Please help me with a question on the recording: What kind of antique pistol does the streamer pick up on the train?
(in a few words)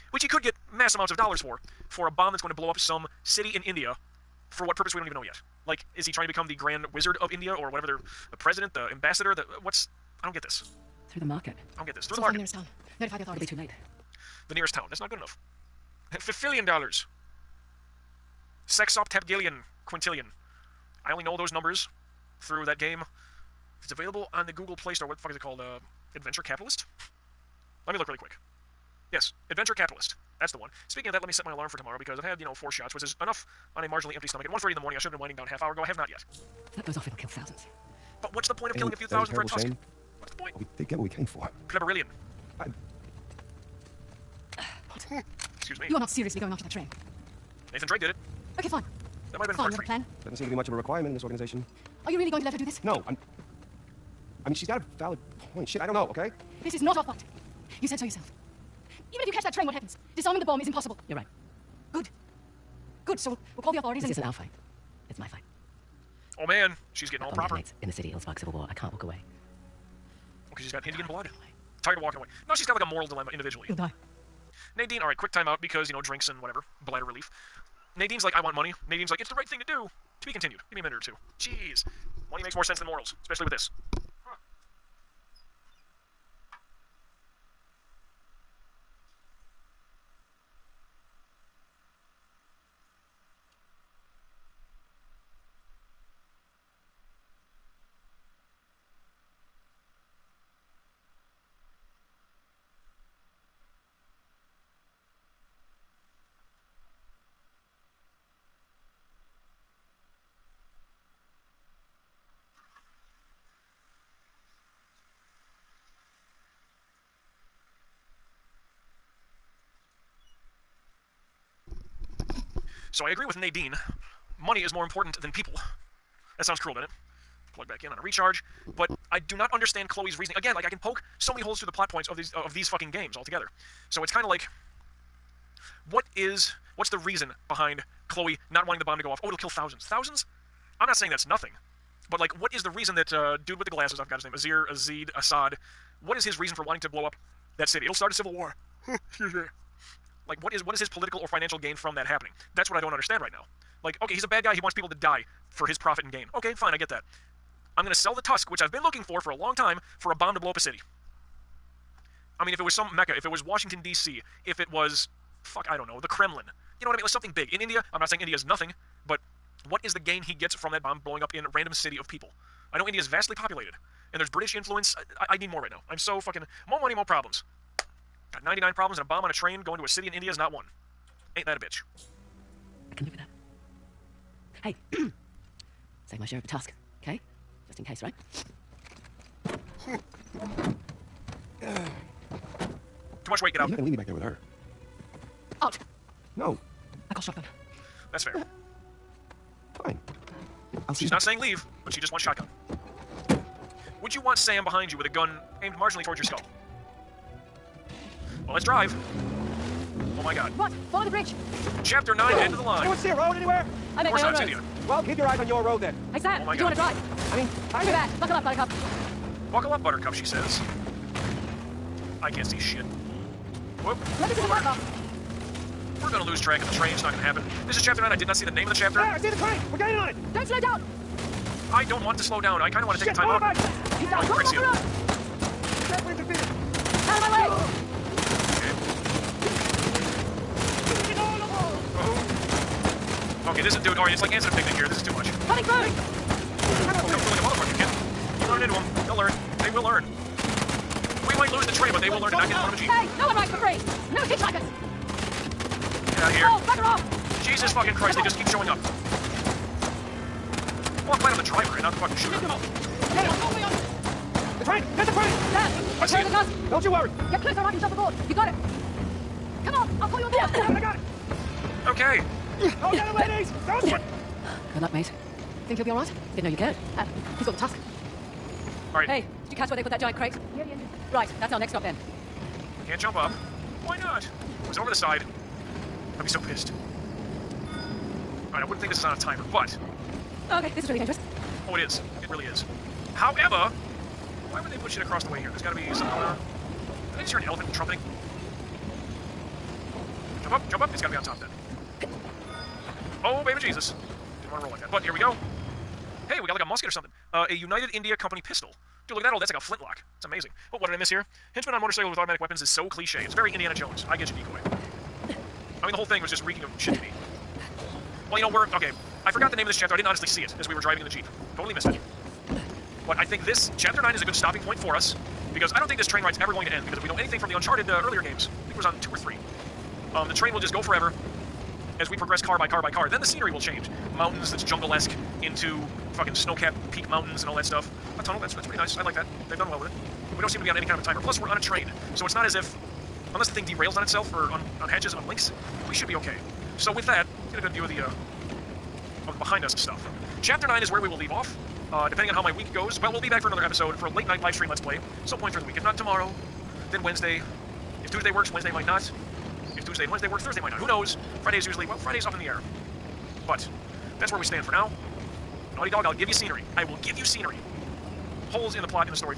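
United India Company pistol.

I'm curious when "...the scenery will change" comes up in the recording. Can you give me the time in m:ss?
5:33.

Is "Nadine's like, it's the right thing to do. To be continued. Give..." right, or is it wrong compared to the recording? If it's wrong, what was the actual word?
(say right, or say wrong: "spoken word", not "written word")
right.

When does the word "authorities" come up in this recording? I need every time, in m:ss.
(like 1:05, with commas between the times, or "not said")
0:13, 1:03.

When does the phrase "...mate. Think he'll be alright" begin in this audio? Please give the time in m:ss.
4:34.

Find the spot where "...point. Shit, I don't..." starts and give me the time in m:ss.
0:55.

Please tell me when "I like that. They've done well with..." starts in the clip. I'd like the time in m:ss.
5:38.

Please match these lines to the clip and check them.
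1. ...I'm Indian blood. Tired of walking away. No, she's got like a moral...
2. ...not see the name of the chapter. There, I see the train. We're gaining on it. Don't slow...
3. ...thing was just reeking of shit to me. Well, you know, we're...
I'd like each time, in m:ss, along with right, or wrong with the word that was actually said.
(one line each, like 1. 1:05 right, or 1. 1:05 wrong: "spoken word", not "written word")
1. 1:10 right
2. 3:48 right
3. 5:16 right.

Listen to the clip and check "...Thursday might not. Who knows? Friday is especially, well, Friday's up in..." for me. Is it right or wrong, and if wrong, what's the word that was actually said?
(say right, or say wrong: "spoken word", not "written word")
wrong: "usually", not "especially".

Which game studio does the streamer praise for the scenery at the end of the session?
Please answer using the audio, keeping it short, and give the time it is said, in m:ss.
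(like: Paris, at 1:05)
Naughty Dog, at 6:05.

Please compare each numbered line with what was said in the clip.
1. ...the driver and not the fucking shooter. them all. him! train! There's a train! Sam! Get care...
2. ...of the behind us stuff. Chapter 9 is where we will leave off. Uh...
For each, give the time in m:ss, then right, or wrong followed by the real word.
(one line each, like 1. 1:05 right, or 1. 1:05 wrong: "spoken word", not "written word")
1. 4:21 right
2. 5:49 right.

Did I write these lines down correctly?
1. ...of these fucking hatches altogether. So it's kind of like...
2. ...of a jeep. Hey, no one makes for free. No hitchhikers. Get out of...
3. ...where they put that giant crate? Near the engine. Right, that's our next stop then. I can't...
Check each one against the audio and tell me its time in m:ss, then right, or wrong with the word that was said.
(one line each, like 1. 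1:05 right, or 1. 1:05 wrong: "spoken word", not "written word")
1. 2:12 wrong: "games", not "hatches"
2. 4:12 wrong: "rides", not "makes"
3. 4:39 right.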